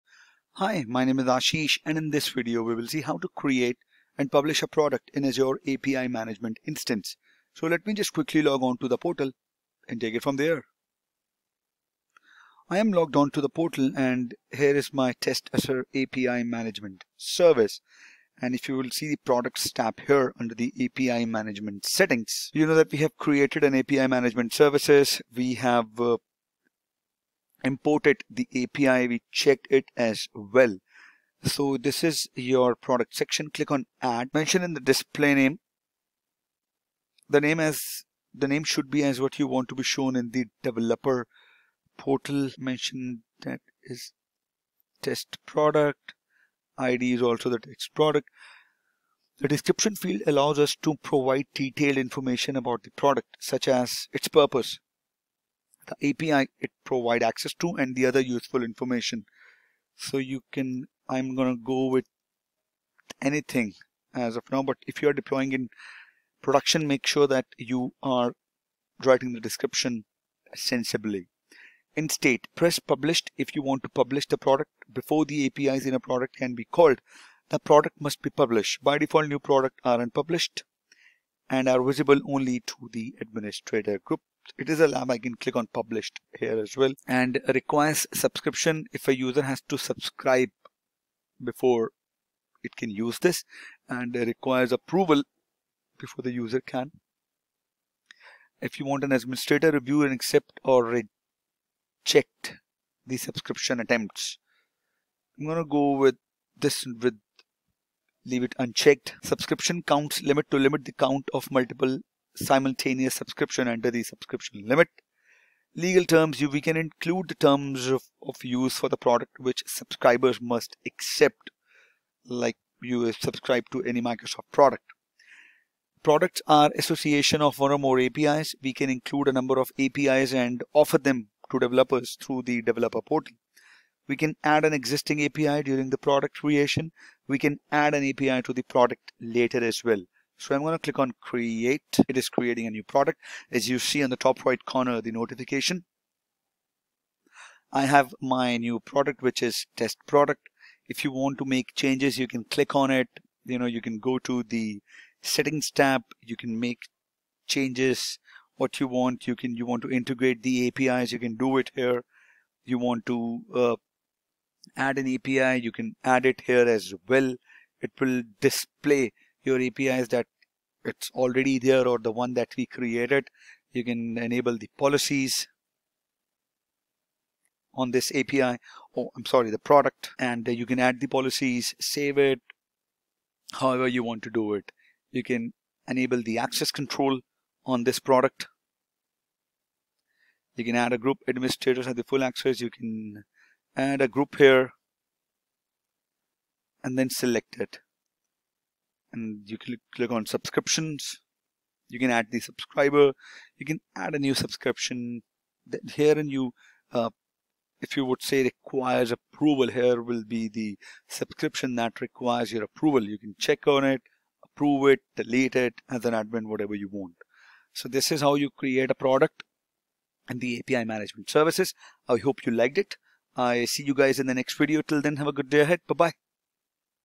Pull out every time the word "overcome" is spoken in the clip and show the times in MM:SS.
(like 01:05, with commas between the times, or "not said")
not said.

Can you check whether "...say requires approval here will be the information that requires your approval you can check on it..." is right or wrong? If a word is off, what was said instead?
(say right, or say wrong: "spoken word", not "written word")
wrong: "subscription", not "information".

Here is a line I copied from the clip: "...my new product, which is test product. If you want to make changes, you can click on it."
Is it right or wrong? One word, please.
right.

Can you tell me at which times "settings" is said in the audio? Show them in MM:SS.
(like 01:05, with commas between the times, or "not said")
00:21, 02:35.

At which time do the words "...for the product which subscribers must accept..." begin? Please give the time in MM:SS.
01:58.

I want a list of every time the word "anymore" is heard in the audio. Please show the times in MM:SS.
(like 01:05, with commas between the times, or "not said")
not said.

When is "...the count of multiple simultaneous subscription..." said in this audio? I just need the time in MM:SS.
01:50.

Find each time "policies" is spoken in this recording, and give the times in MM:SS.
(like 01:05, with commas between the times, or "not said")
02:54, 03:01.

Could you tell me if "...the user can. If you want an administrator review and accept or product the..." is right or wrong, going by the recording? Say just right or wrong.
wrong.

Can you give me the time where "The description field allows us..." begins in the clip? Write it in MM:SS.
00:49.